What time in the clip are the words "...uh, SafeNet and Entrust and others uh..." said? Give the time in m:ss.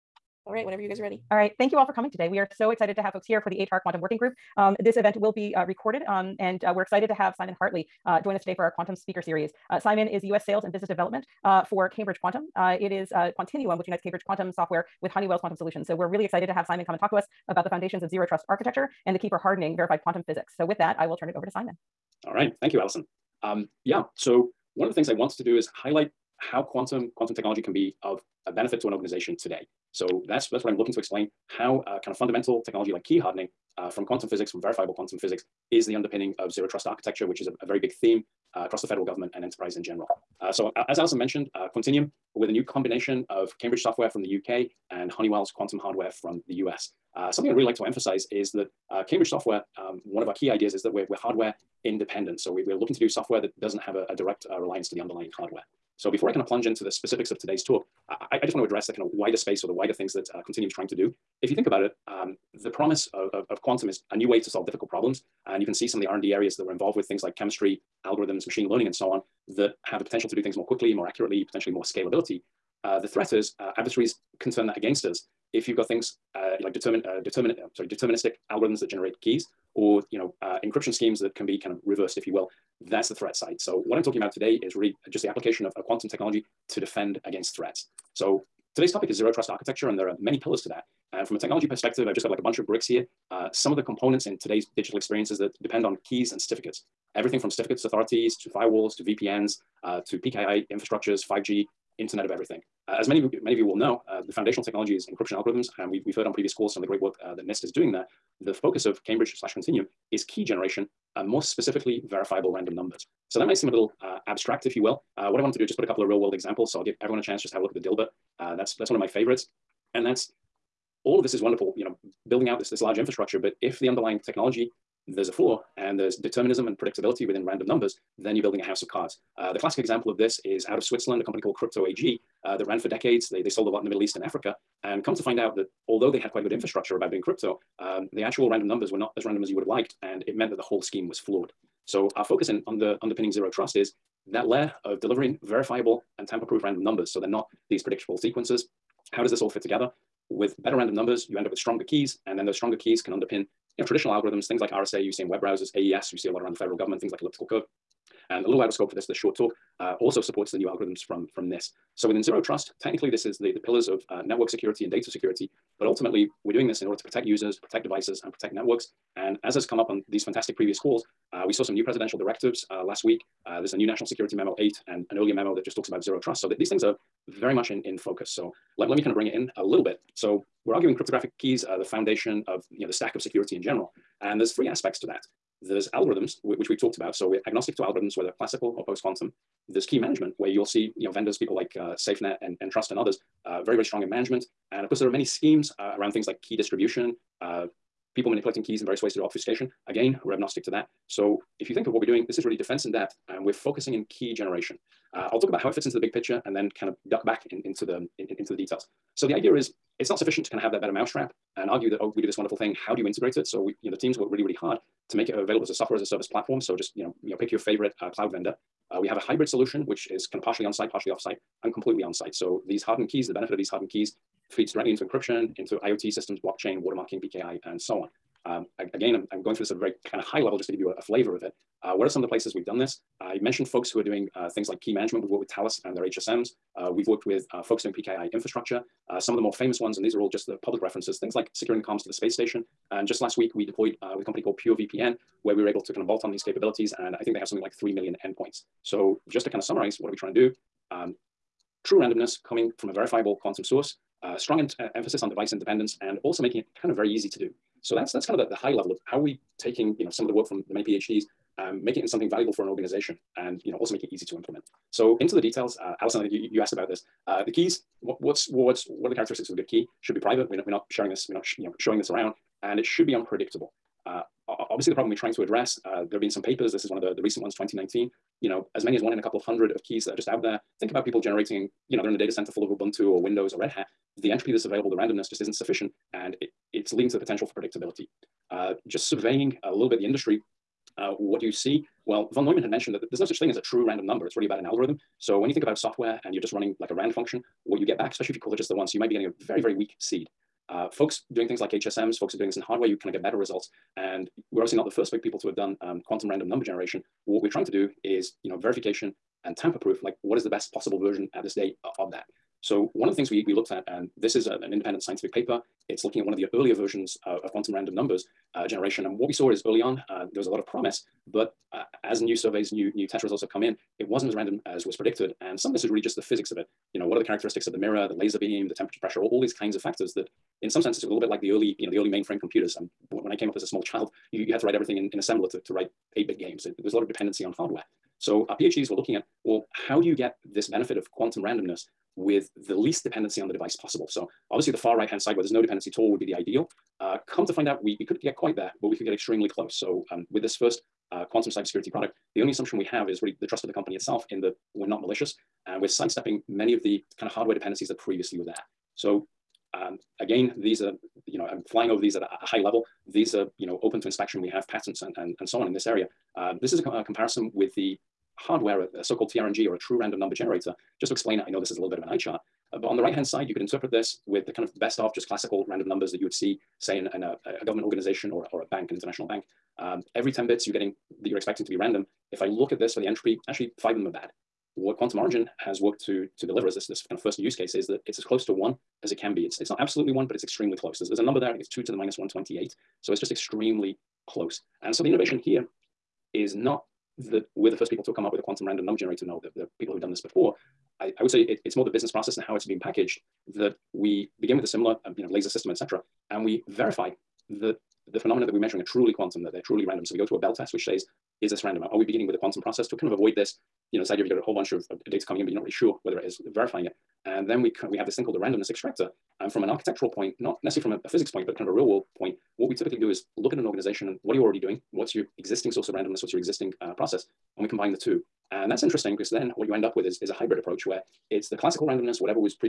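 3:11.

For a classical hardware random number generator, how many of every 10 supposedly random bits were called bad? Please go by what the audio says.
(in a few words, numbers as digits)
5.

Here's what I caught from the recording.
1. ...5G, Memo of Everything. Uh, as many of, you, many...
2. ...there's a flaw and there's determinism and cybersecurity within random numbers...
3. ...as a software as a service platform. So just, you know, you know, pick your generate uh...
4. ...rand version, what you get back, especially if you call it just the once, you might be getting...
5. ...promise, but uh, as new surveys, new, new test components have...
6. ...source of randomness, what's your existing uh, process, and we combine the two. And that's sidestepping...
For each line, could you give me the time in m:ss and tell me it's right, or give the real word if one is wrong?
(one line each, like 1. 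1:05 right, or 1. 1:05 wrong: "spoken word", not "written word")
1. 1:41 wrong: "Internet", not "Memo"
2. 2:05 wrong: "predictability", not "cybersecurity"
3. 3:35 wrong: "favorite", not "generate"
4. 4:56 wrong: "function", not "version"
5. 5:20 wrong: "results", not "components"
6. 7:05 wrong: "interesting", not "sidestepping".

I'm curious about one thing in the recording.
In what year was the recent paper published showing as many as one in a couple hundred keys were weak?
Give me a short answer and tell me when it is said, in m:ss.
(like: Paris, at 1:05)
2019, at 4:37.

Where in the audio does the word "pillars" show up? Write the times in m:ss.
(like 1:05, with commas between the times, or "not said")
1:30, 2:43.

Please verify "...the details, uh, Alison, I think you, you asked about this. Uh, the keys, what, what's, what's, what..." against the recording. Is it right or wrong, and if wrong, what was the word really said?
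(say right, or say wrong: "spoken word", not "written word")
right.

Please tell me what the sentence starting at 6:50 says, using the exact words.
So we go through a bell test, which says is this random?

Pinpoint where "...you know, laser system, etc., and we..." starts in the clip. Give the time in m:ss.
6:45.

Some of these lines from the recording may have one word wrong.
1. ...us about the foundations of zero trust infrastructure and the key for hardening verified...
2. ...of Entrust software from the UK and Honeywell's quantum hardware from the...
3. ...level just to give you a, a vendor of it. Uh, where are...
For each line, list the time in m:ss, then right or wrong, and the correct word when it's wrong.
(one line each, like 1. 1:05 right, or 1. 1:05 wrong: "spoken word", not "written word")
1. 0:17 wrong: "architecture", not "infrastructure"
2. 0:43 wrong: "Cambridge", not "Entrust"
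3. 3:50 wrong: "flavor", not "vendor".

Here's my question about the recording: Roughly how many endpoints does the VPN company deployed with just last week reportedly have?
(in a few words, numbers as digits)
3 million.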